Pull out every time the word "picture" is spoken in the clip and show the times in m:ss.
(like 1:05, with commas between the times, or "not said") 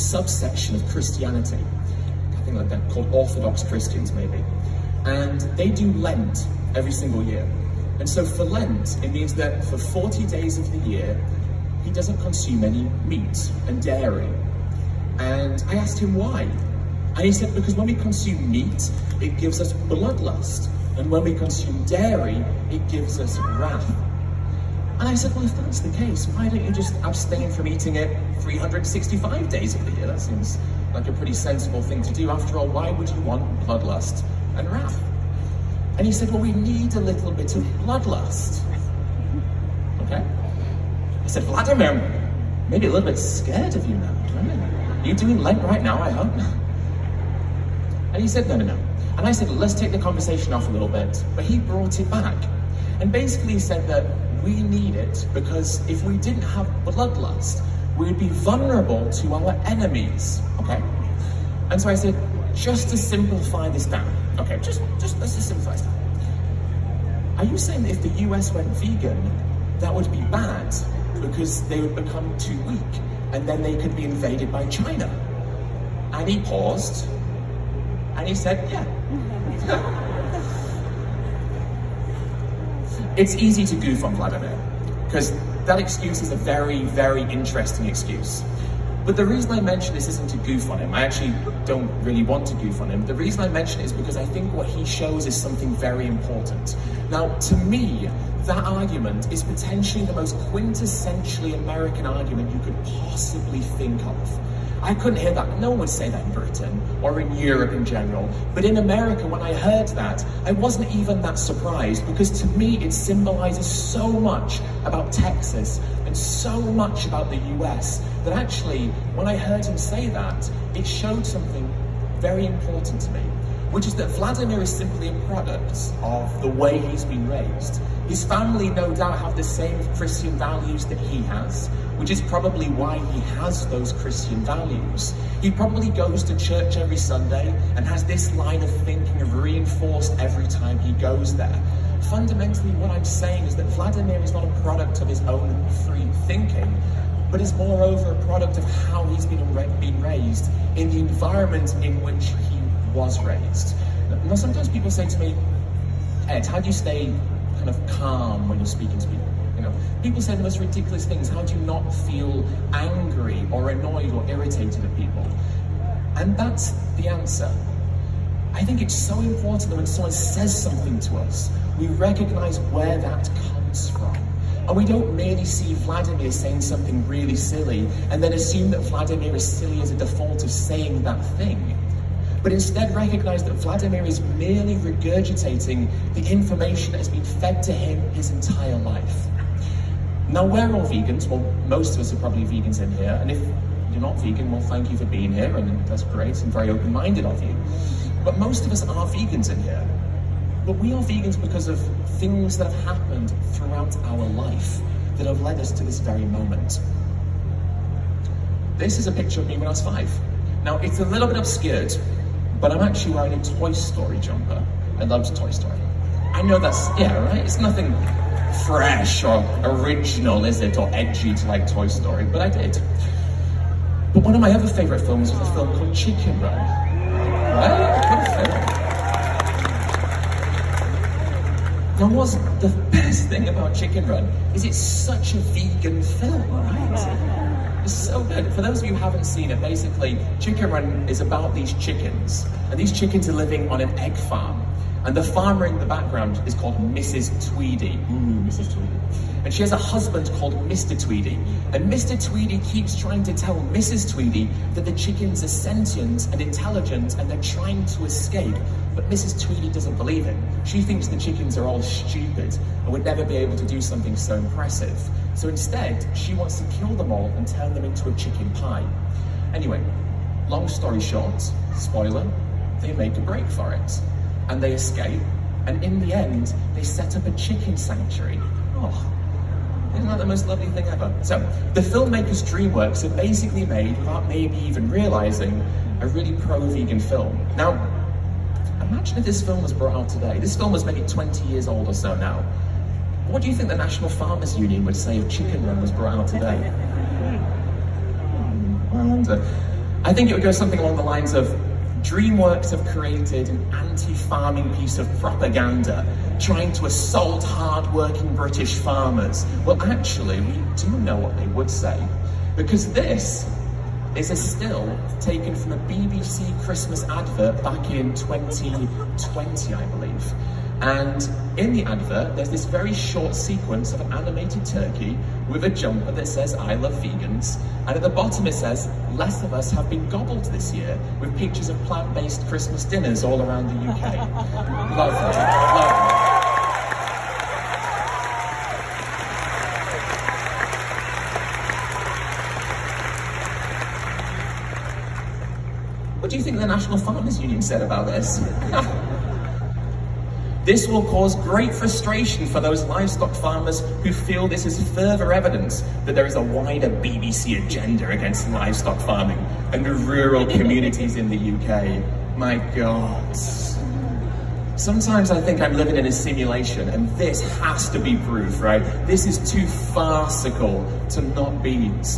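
3:29, 5:31.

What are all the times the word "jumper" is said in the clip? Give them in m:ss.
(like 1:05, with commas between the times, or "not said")
3:34, 5:25.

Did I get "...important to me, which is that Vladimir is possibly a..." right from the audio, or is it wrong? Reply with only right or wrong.
wrong.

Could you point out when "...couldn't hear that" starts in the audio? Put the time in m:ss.
1:44.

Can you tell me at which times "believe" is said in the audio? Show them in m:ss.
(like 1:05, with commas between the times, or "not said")
4:19, 5:19.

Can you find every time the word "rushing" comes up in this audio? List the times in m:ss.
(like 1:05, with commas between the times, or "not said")
not said.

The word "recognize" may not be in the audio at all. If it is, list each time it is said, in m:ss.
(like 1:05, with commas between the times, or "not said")
2:51, 3:02.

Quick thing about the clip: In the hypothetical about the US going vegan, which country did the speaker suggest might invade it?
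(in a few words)
China.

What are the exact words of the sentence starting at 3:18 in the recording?
But most of us are vegans in here.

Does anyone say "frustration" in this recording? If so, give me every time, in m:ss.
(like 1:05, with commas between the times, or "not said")
5:51.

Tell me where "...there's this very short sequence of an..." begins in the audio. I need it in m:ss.
5:22.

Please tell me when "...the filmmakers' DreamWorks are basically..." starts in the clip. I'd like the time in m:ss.
4:41.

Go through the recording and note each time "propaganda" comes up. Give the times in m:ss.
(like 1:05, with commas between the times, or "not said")
5:05.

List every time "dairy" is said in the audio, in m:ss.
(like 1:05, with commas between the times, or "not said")
0:13, 0:21.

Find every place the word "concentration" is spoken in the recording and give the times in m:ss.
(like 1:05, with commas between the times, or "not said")
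not said.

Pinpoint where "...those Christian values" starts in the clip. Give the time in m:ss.
2:13.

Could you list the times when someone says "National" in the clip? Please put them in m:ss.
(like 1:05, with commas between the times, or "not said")
4:53, 5:46.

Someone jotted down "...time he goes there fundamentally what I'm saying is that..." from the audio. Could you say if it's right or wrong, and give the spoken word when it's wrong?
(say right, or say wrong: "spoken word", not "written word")
right.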